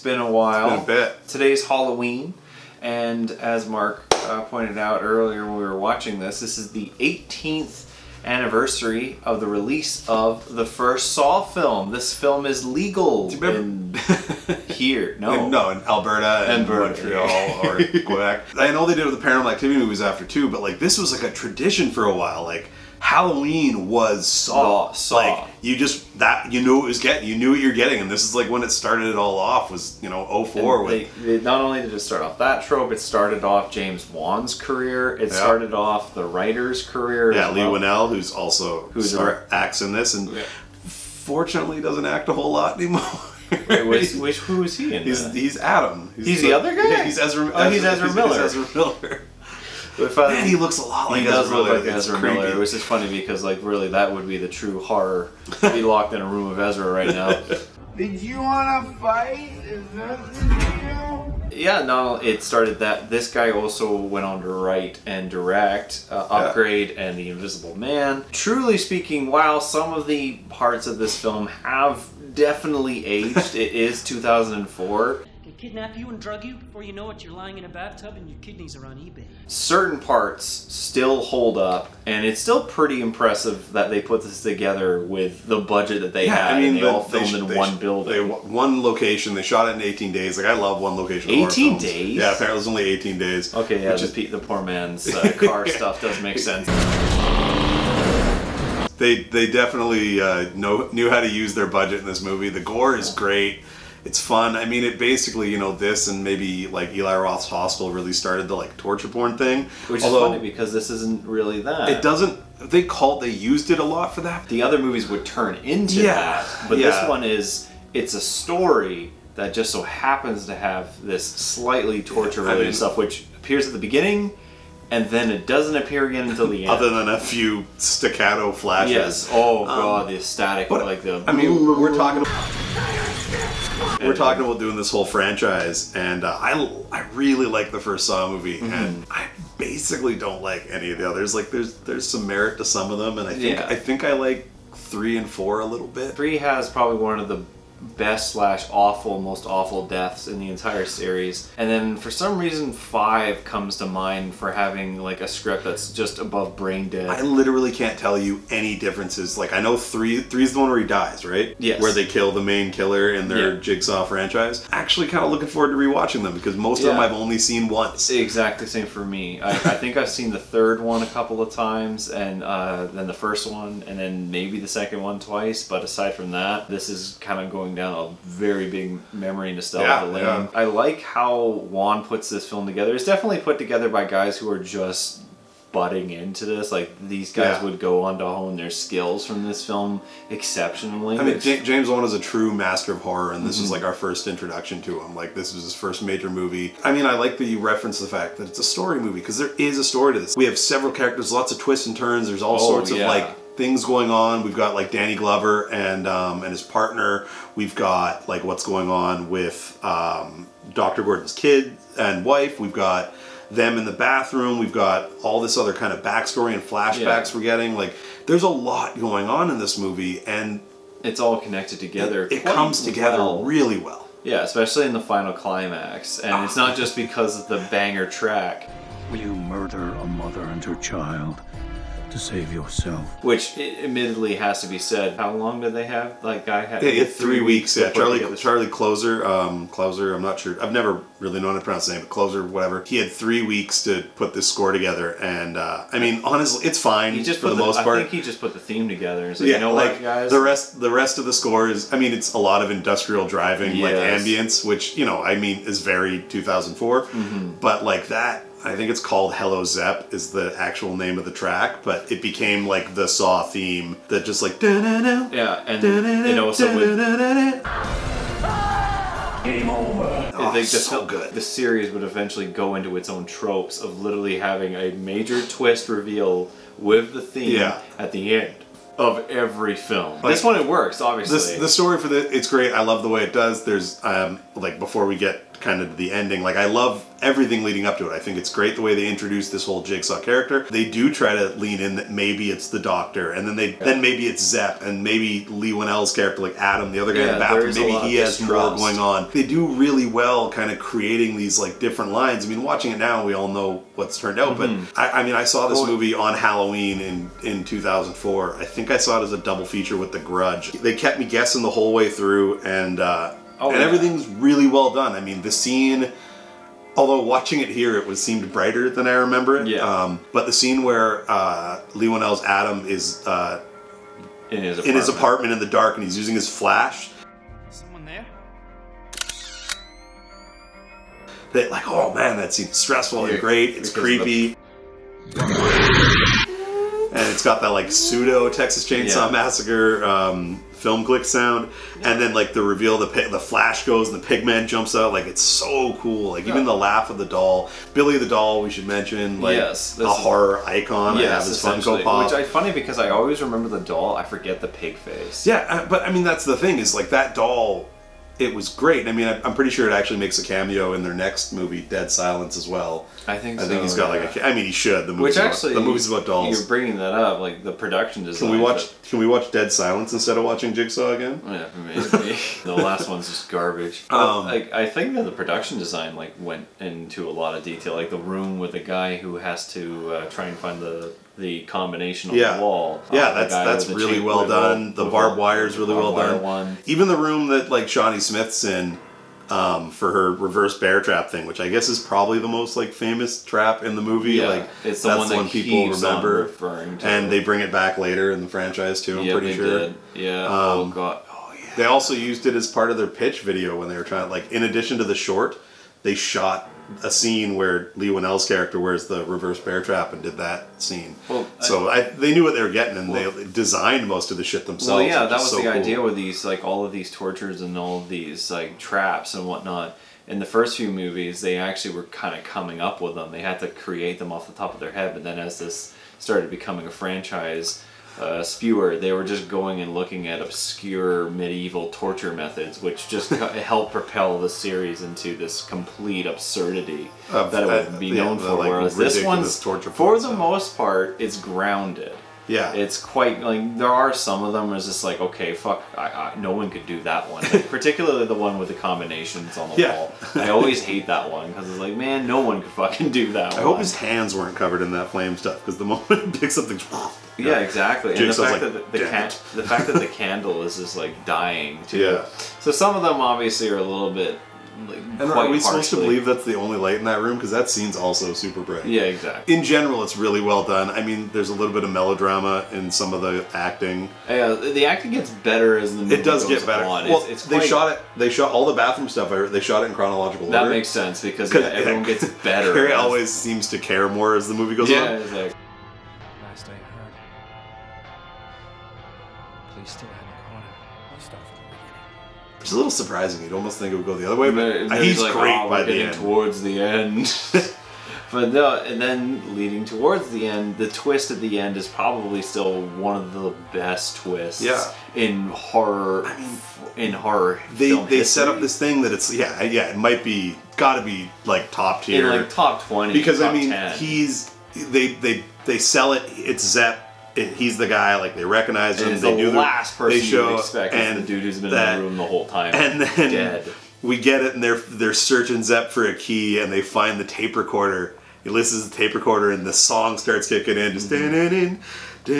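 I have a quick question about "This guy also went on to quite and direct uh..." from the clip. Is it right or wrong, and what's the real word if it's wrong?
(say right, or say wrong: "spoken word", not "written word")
wrong: "write", not "quite".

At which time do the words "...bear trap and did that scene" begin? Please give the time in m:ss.
6:49.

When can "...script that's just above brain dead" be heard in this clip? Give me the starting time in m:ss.
2:35.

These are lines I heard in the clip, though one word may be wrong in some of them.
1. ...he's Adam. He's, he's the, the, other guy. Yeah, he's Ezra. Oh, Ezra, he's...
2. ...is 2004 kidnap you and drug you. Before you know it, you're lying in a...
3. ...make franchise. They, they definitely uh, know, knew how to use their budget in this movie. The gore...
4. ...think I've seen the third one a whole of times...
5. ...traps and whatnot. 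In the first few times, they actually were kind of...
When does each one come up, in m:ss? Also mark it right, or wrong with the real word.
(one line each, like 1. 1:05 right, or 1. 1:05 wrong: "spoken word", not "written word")
1. 0:45 right
2. 1:13 right
3. 1:36 wrong: "sense", not "franchise"
4. 2:49 wrong: "couple", not "whole"
5. 6:58 wrong: "movies", not "times".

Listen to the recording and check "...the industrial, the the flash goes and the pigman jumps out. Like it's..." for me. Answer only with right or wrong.
wrong.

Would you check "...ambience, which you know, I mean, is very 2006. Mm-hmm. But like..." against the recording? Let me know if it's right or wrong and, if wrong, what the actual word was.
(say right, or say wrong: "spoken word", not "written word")
wrong: "2004", not "2006".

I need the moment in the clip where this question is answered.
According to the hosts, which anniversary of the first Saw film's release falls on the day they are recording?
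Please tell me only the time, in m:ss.
0:06.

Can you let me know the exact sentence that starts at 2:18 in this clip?
and I basically don't like any of the others.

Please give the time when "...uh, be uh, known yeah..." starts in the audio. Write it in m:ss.
7:17.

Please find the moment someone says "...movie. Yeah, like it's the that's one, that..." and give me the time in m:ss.
6:34.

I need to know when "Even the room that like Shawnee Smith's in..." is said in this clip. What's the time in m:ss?
6:26.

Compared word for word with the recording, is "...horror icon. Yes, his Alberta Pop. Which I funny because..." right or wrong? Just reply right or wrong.
wrong.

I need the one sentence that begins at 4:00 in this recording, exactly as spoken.
I've never really known how to pronounce his name, but Clouser, whatever.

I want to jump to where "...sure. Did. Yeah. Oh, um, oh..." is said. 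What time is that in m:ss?
6:39.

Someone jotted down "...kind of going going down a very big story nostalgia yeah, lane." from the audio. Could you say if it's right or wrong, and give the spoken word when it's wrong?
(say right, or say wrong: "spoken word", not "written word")
wrong: "memory", not "story".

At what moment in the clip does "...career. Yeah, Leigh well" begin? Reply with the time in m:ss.
0:36.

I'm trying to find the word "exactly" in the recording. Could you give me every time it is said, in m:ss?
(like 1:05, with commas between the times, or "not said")
2:48, 7:37, 7:49.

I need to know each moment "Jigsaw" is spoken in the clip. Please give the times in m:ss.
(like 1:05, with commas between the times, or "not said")
2:43, 4:49, 6:10.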